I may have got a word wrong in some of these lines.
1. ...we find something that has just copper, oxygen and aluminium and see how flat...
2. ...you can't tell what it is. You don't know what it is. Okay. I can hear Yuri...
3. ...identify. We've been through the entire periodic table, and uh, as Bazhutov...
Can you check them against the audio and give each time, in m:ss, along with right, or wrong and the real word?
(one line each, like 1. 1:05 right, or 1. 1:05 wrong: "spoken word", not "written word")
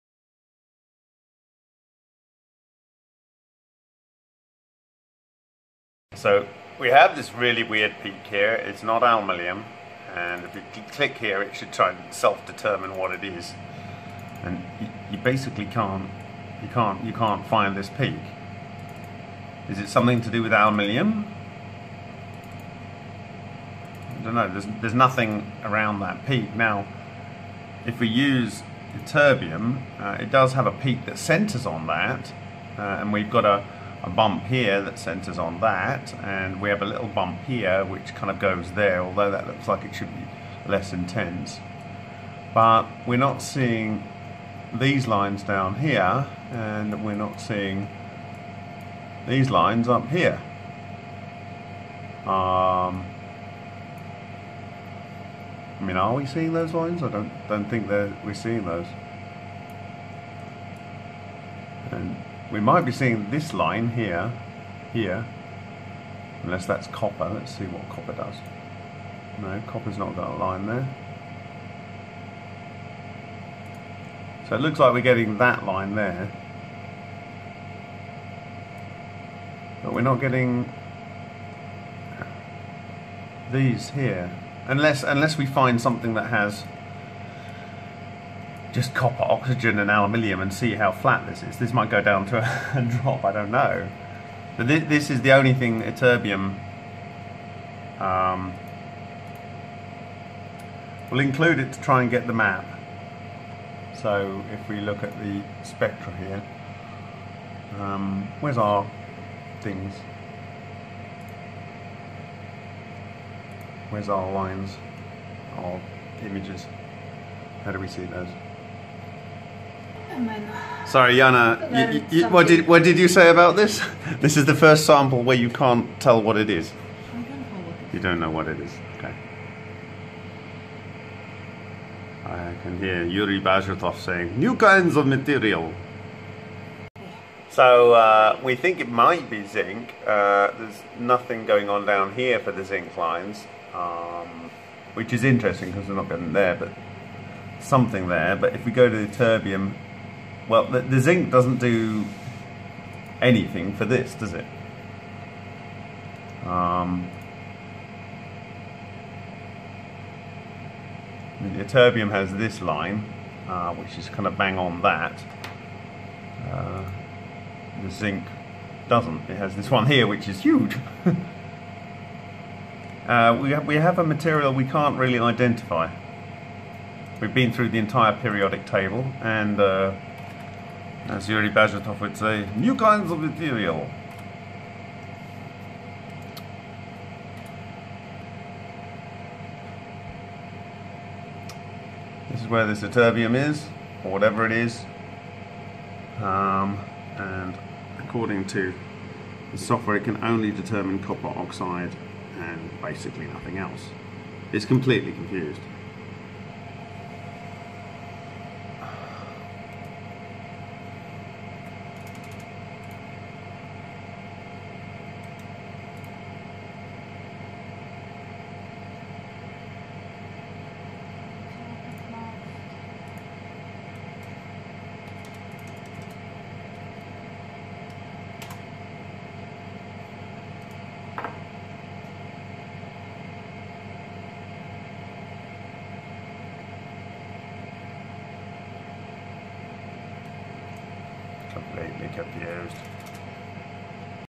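1. 1:25 right
2. 2:05 right
3. 2:55 wrong: "Yuri", not "Bazhutov".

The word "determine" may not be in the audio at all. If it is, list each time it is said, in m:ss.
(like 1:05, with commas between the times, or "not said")
0:12, 3:20.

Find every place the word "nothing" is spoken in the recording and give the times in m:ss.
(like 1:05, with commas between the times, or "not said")
0:24, 2:20, 3:23.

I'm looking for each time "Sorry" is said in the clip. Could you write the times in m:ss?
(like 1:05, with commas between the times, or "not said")
2:00.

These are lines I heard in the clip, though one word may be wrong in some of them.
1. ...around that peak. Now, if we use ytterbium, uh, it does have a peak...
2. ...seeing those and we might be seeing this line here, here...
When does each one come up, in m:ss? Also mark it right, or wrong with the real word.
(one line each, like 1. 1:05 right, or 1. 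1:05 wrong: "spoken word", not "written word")
1. 0:25 right
2. 0:58 right.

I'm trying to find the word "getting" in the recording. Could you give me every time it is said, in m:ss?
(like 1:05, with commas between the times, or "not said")
1:15, 1:20, 2:26.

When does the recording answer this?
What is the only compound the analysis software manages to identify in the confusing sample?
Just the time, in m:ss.
3:20.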